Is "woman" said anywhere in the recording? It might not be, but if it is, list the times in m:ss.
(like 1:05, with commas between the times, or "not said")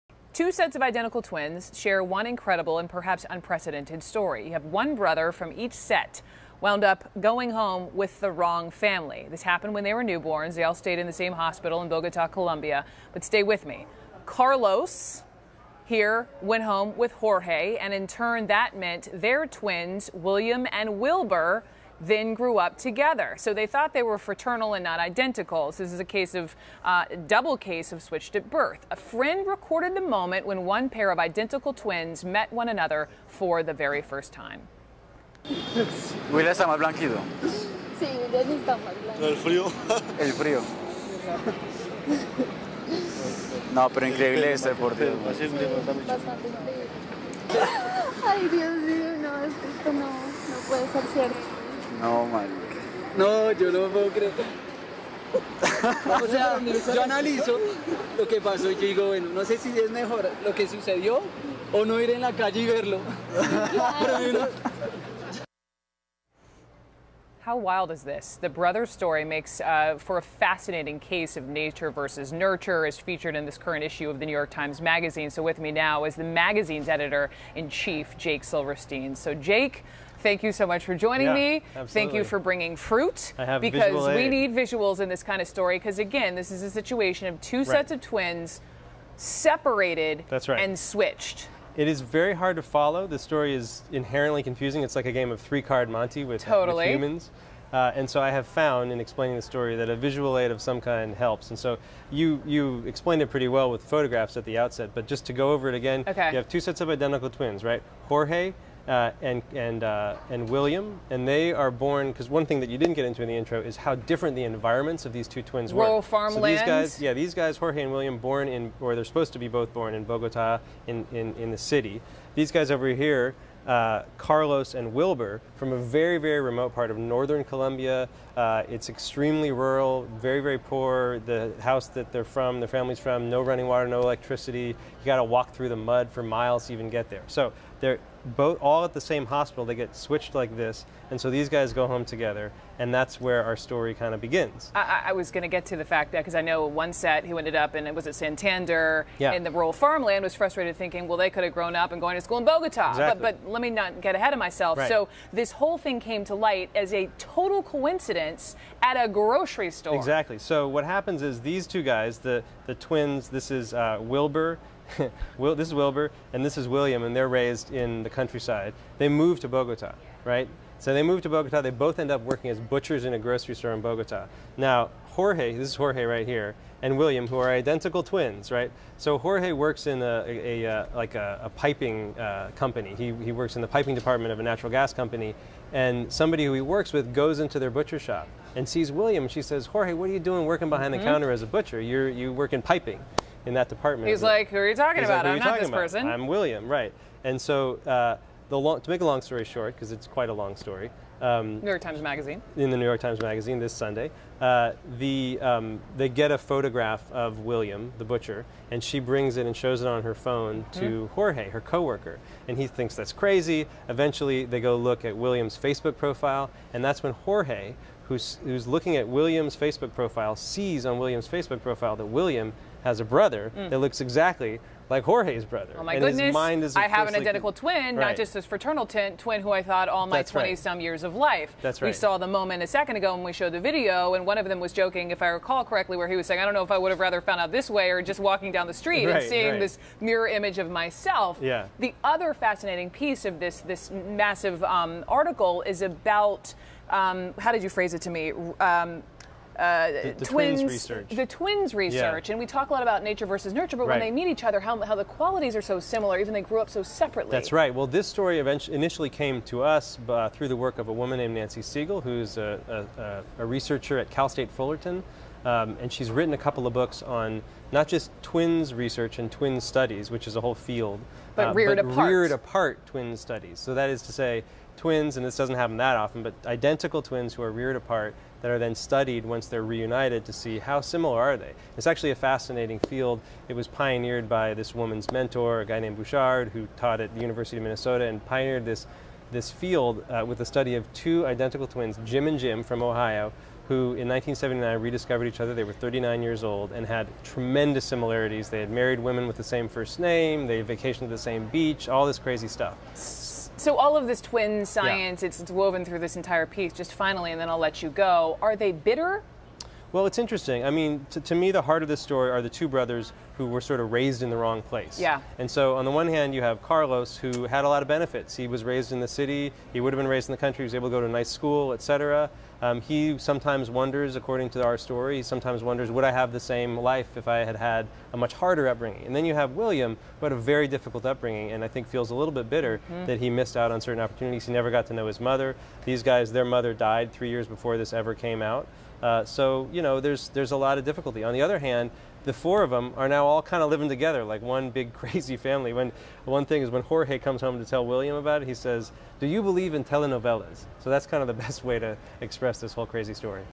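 4:20, 4:44.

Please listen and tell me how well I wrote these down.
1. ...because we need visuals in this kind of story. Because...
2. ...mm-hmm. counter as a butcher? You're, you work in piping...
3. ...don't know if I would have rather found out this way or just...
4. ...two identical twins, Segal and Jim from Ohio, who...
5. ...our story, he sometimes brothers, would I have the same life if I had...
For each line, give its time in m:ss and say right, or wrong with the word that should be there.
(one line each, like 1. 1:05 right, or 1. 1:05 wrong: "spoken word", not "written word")
1. 1:23 right
2. 3:11 right
3. 3:56 right
4. 4:50 wrong: "Jim", not "Segal"
5. 5:24 wrong: "wonders", not "brothers".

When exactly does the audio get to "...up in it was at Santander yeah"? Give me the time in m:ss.
2:27.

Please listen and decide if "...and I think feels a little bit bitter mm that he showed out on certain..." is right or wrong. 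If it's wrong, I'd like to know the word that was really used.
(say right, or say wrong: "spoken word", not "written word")
wrong: "missed", not "showed".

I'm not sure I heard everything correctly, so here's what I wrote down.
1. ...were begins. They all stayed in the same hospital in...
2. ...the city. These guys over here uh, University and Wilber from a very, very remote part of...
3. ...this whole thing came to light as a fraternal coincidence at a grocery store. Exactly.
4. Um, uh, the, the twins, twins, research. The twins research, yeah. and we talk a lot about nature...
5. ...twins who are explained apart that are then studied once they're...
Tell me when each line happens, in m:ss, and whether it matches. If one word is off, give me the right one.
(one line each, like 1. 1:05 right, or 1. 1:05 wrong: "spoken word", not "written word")
1. 0:09 wrong: "newborns", not "begins"
2. 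2:01 wrong: "Carlos", not "University"
3. 2:35 wrong: "total", not "fraternal"
4. 4:08 right
5. 4:37 wrong: "reared", not "explained".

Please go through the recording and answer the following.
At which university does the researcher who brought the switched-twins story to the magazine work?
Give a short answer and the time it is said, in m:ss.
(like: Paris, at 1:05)
Cal State Fullerton, at 4:24.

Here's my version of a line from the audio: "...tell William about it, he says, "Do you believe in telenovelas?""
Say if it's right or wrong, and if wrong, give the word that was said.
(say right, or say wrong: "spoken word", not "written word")
right.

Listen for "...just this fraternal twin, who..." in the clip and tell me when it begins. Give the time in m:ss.
3:48.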